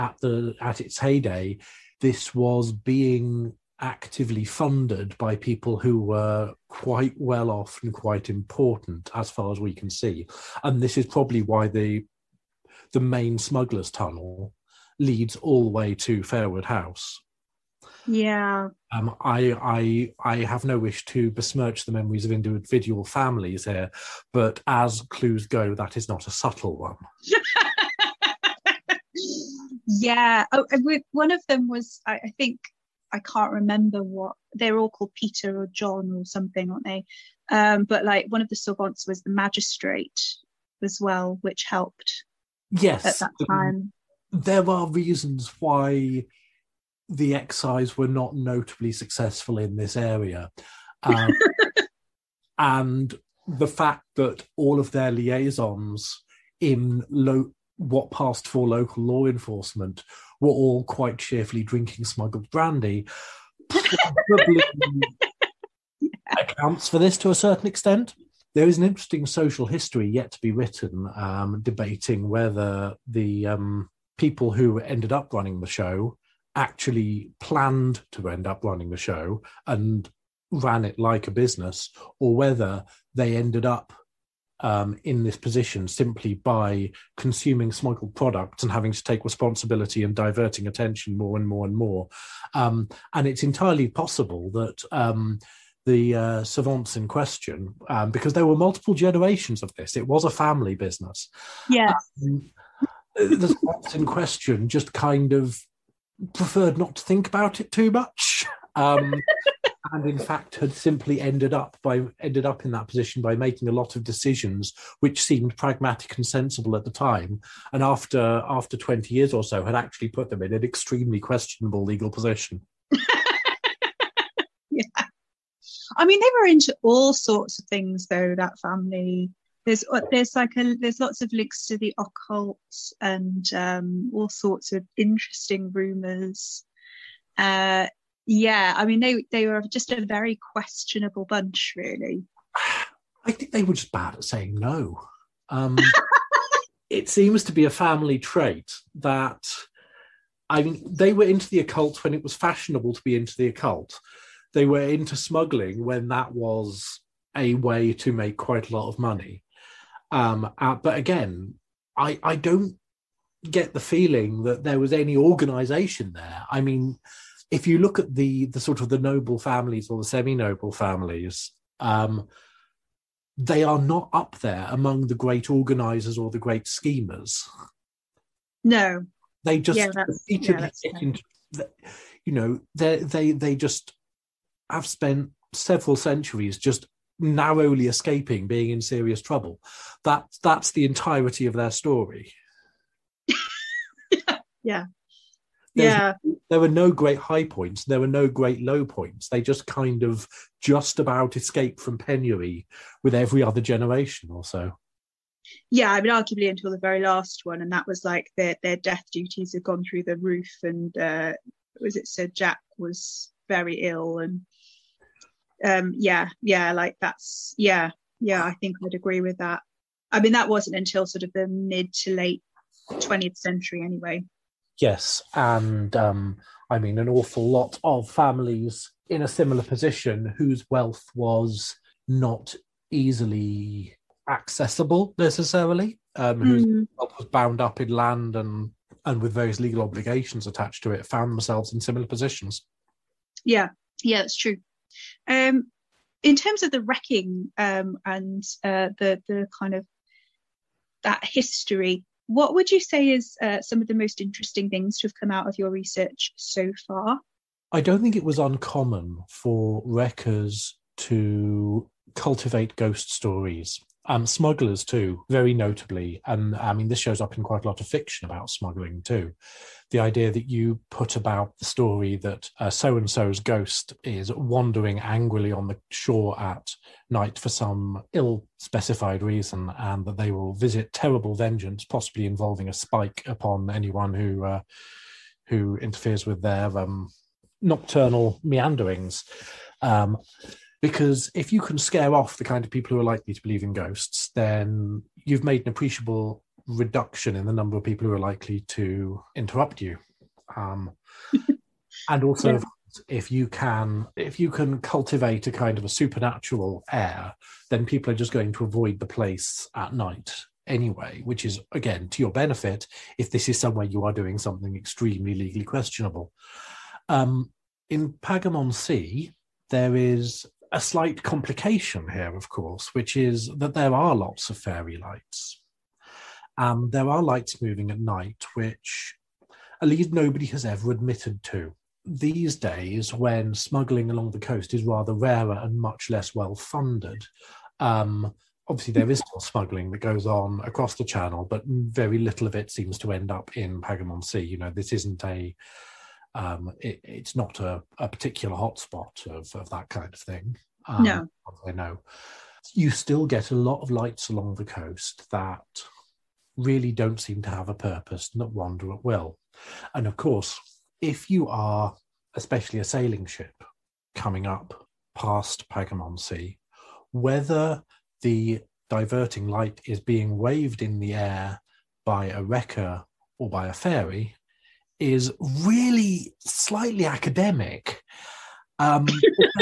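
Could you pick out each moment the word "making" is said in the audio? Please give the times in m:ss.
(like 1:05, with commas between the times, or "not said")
1:53.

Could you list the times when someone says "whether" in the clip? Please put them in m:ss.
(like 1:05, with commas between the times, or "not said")
1:12, 1:22, 6:07.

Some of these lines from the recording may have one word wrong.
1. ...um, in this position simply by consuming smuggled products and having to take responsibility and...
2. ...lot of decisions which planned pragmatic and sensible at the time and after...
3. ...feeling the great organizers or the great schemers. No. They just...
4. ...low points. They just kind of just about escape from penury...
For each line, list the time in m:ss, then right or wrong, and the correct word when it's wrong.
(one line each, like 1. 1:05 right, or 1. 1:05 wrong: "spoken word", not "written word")
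1. 1:24 right
2. 1:53 wrong: "seemed", not "planned"
3. 2:54 wrong: "among", not "feeling"
4. 3:18 right.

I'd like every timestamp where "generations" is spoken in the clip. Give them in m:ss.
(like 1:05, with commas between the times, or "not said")
1:38, 3:23.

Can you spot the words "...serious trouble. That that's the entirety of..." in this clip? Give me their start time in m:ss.
3:08.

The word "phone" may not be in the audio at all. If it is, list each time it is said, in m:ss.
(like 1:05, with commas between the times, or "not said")
not said.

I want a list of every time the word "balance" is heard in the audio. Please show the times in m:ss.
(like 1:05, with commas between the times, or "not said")
not said.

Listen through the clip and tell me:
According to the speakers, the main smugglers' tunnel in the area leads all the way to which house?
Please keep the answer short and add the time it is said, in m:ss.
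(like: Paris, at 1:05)
Fairwood House, at 0:16.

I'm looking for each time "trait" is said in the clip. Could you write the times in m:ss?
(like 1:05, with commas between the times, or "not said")
2:28.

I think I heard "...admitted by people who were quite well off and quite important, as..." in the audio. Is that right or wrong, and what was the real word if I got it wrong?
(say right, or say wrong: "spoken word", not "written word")
wrong: "funded", not "admitted".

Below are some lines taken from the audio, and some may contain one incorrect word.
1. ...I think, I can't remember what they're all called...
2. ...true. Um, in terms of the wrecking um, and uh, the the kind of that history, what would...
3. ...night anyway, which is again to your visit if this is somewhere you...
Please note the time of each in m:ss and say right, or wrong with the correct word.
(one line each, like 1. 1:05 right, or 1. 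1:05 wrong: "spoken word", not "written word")
1. 0:32 right
2. 4:04 right
3. 5:09 wrong: "benefit", not "visit".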